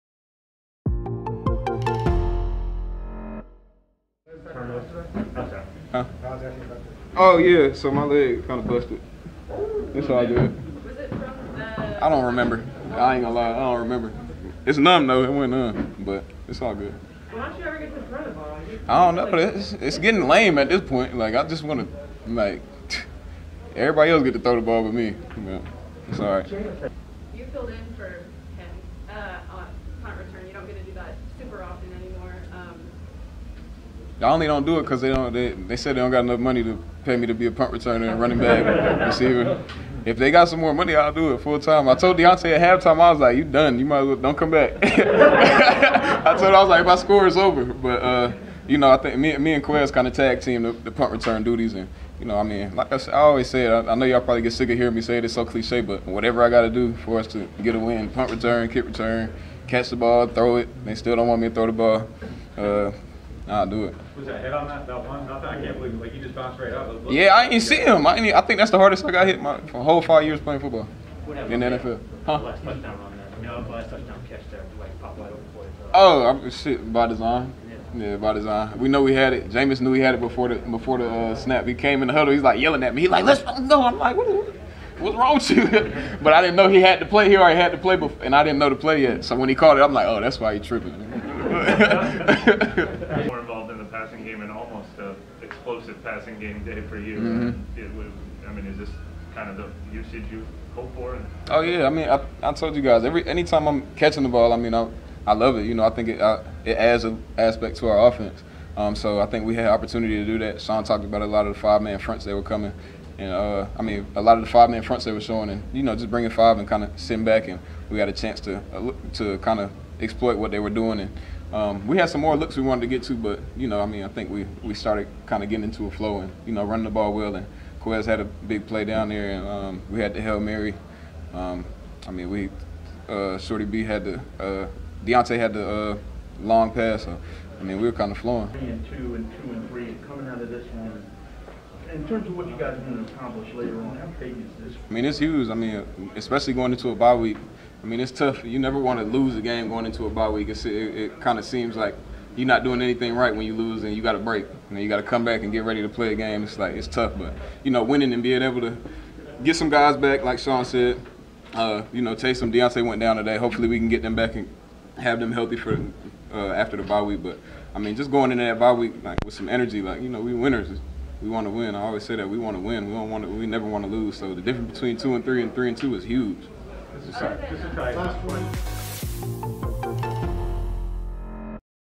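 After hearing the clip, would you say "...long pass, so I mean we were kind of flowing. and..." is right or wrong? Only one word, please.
right.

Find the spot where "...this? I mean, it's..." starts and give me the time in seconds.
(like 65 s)
144 s.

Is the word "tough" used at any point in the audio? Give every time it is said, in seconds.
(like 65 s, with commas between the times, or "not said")
148 s, 156 s.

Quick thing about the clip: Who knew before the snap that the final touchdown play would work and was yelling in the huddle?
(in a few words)
Jameis.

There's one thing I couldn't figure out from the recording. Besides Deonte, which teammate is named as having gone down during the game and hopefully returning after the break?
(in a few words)
Taysom.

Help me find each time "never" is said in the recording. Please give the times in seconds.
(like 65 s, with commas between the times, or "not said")
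148 s, 173 s.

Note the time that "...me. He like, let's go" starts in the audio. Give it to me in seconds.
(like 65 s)
82 s.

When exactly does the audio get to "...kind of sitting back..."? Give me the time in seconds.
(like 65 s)
116 s.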